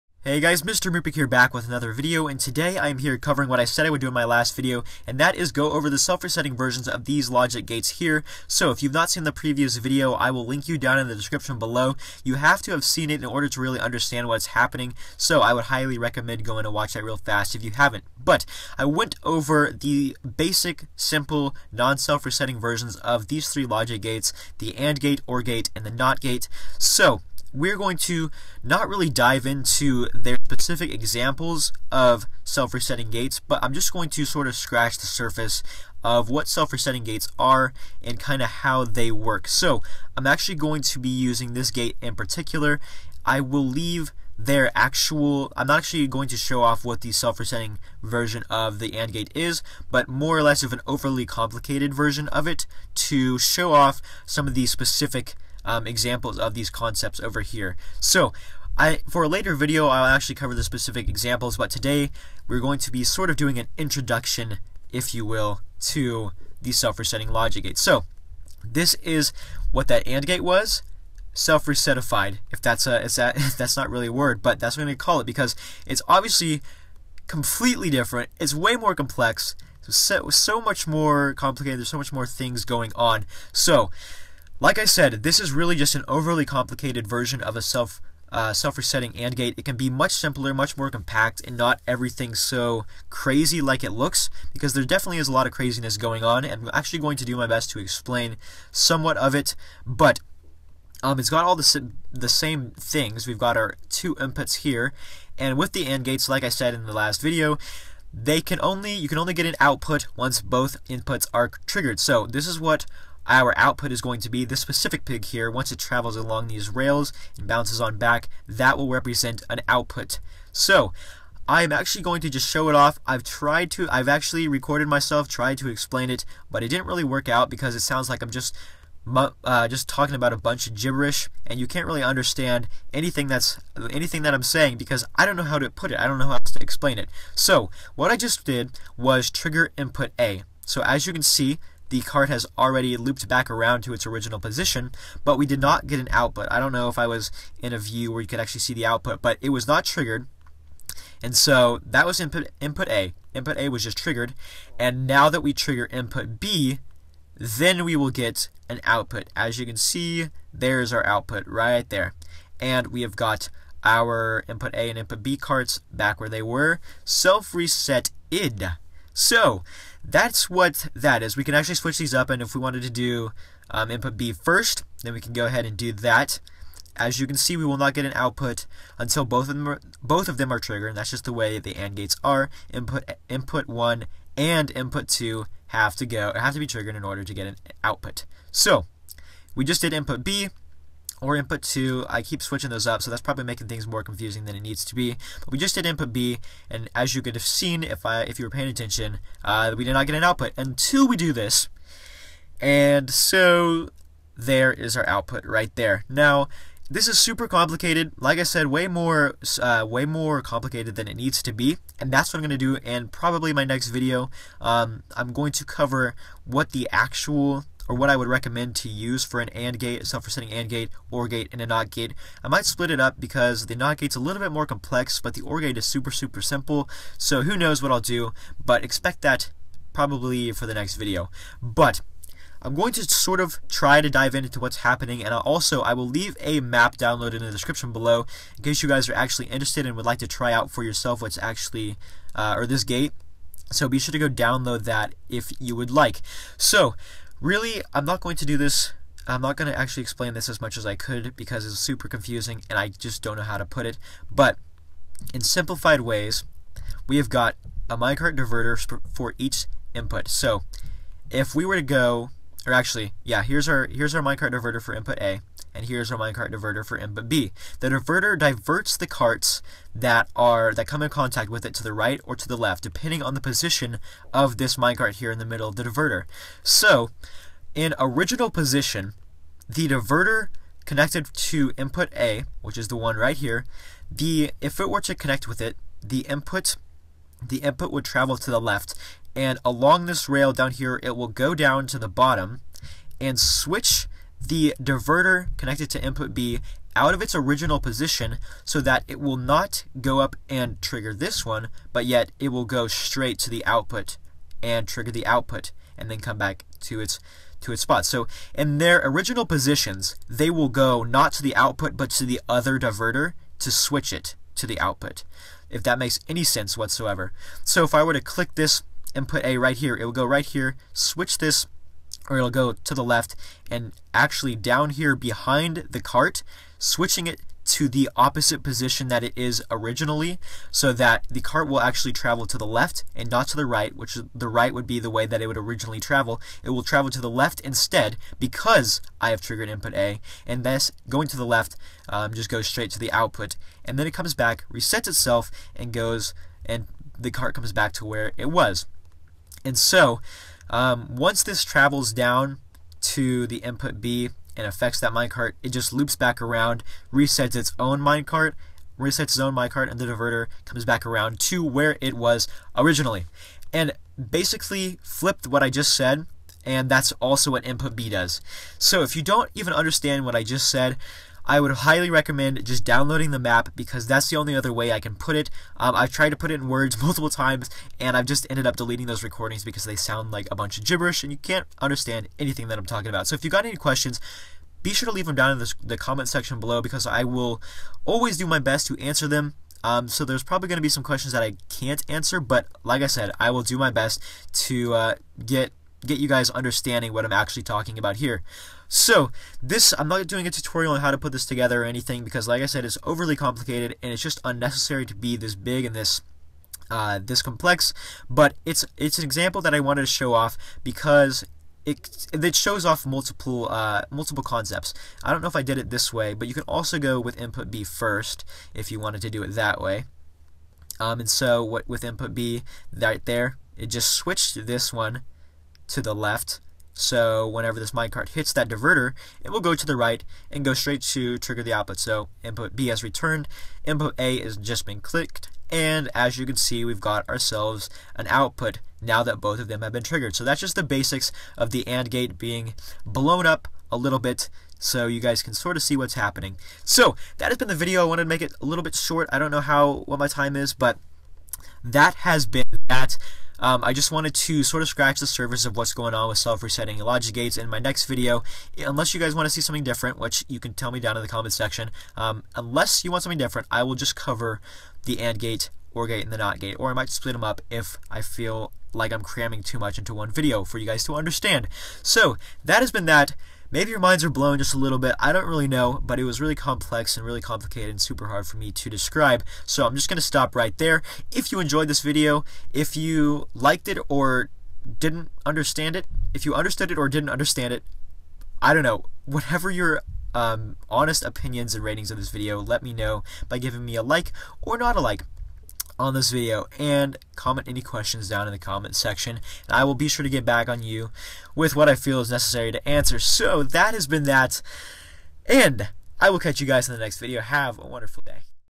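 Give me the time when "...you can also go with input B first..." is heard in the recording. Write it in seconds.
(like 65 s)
416 s.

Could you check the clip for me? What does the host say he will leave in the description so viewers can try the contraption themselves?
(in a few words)
map download.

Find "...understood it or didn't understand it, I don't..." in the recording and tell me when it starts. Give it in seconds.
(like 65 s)
486 s.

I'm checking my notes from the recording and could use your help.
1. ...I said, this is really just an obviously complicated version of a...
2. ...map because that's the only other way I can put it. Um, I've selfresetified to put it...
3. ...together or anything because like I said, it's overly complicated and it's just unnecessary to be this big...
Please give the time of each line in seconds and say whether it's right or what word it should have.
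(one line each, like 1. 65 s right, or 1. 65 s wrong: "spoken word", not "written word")
1. 84 s wrong: "overly", not "obviously"
2. 373 s wrong: "tried", not "selfresetified"
3. 401 s right.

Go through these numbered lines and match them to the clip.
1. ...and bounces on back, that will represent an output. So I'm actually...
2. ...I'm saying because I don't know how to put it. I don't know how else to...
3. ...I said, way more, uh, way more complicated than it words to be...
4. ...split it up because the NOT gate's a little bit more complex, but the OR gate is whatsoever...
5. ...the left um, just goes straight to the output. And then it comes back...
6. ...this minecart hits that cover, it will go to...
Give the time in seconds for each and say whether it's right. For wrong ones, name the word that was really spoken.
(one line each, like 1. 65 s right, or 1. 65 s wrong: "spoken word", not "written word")
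1. 117 s right
2. 134 s right
3. 208 s wrong: "needs", not "words"
4. 222 s wrong: "super", not "whatsoever"
5. 341 s right
6. 427 s wrong: "diverter", not "cover".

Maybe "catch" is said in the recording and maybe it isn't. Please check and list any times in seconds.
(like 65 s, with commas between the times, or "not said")
506 s.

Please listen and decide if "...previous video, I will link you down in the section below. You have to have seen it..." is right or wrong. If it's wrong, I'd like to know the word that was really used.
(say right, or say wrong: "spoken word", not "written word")
wrong: "description", not "section".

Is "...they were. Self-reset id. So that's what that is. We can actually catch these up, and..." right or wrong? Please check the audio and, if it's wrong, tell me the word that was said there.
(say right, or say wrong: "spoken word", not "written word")
wrong: "switch", not "catch".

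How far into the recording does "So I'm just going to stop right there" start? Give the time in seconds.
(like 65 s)
479 s.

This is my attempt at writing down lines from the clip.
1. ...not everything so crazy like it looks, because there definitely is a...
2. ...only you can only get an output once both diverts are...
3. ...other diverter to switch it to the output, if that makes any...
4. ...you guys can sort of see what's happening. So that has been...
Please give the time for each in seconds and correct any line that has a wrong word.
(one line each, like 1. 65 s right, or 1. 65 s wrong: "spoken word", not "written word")
1. 91 s right
2. 108 s wrong: "inputs", not "diverts"
3. 312 s right
4. 445 s right.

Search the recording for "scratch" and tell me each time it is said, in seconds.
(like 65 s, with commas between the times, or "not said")
34 s, 454 s.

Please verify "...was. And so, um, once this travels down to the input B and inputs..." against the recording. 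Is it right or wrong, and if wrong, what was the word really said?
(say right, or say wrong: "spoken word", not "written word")
wrong: "affects", not "inputs".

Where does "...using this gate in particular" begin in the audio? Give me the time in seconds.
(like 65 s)
41 s.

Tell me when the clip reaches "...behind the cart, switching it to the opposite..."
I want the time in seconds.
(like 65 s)
325 s.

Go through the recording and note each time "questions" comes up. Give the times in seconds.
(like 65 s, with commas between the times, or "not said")
383 s, 391 s, 497 s.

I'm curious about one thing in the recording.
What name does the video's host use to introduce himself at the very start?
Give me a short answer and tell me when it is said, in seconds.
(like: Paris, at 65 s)
Mr. Moopig, at 0 s.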